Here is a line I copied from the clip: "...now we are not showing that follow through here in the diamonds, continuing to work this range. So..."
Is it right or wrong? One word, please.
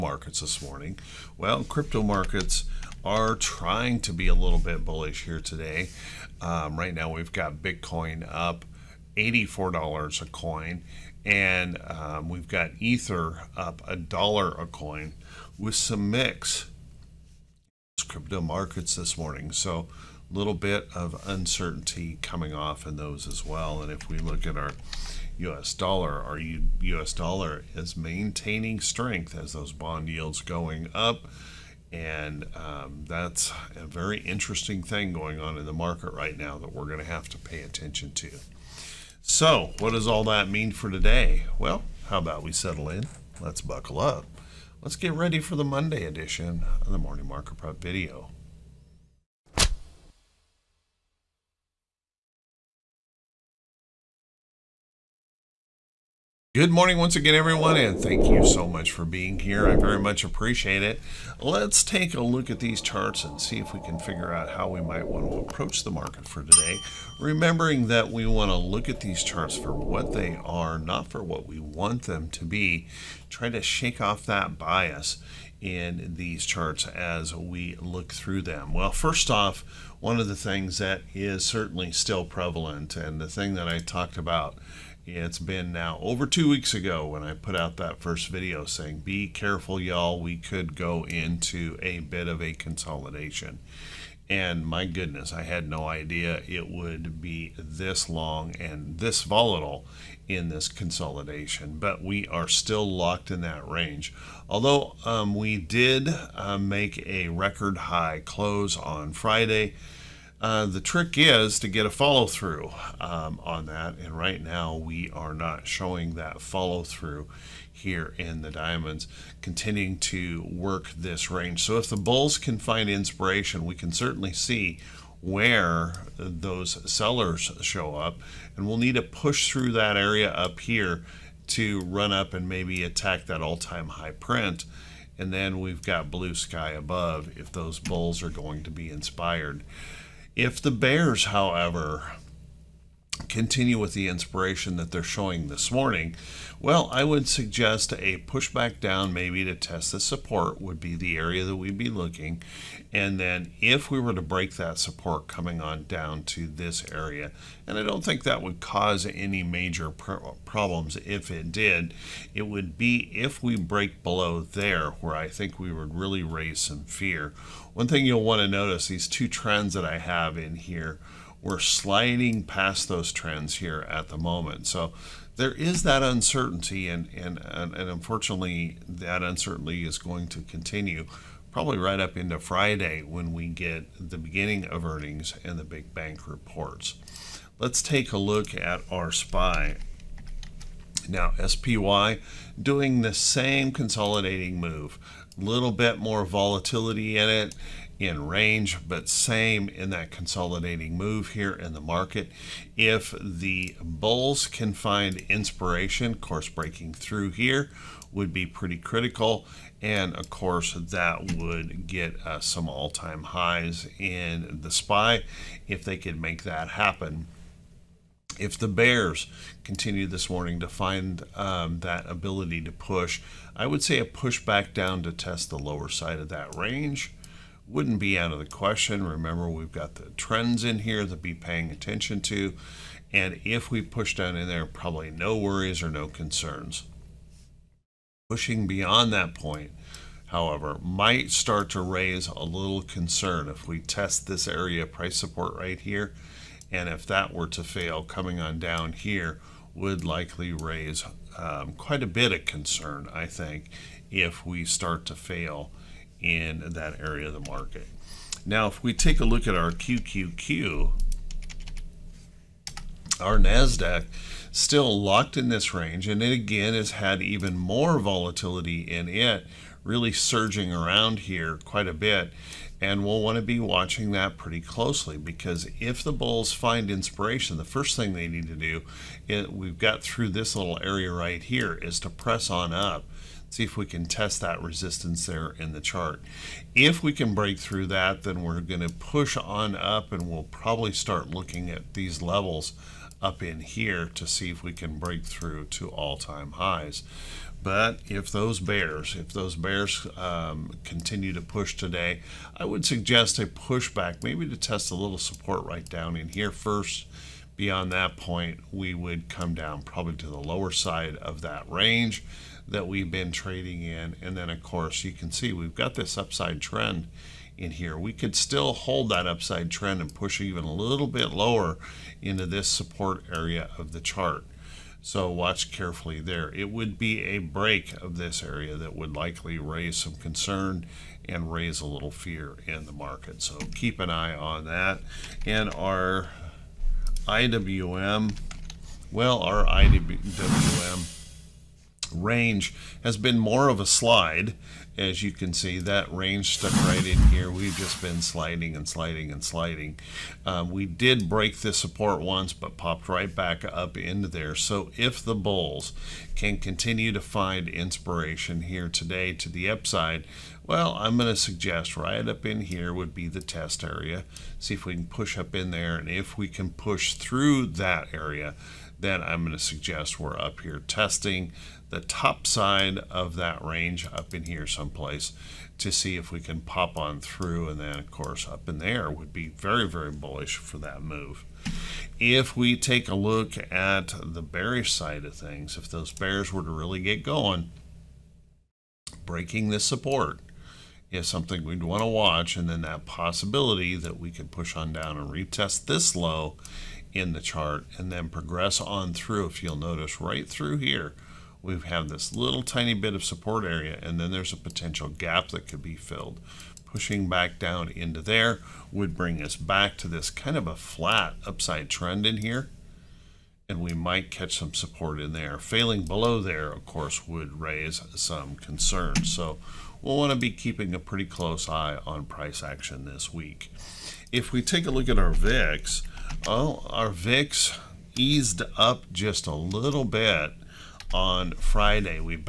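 right.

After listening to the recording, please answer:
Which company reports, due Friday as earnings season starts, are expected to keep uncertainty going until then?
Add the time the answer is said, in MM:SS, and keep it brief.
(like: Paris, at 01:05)
big bank reports, at 03:05.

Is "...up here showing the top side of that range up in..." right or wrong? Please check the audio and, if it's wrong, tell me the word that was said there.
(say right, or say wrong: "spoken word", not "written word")
wrong: "testing", not "showing".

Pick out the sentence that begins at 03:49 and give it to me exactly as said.
Remember, we've got the trends in here to be paying attention to.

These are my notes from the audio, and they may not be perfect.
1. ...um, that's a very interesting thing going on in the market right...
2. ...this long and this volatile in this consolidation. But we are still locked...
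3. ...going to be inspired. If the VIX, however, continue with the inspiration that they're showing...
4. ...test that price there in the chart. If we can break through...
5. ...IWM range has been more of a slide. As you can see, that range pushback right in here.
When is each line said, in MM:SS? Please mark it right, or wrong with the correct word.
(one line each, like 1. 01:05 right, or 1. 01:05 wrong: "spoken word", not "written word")
1. 00:32 right
2. 01:37 right
3. 02:18 wrong: "Bears", not "VIX"
4. 04:44 wrong: "resistance", not "price"
5. 05:39 wrong: "stuck", not "pushback".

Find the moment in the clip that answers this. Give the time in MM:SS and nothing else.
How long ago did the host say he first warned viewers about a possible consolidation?
01:26.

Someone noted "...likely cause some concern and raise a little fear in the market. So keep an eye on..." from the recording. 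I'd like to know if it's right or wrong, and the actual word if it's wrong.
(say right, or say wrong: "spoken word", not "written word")
wrong: "raise", not "cause".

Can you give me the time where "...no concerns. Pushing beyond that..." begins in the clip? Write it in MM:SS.
03:55.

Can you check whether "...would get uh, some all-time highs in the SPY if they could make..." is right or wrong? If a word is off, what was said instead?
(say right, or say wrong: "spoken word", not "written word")
right.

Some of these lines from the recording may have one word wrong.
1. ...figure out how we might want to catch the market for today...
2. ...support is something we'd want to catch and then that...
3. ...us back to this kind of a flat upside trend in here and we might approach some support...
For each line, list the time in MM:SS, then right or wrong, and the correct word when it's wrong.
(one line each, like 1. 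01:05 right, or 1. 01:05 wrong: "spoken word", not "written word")
1. 01:03 wrong: "approach", not "catch"
2. 06:29 wrong: "watch", not "catch"
3. 06:49 wrong: "catch", not "approach".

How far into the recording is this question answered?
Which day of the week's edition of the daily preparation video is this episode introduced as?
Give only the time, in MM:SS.
00:45.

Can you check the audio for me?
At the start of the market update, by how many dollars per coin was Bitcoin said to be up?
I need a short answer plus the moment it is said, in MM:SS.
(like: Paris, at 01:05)
$84, at 00:09.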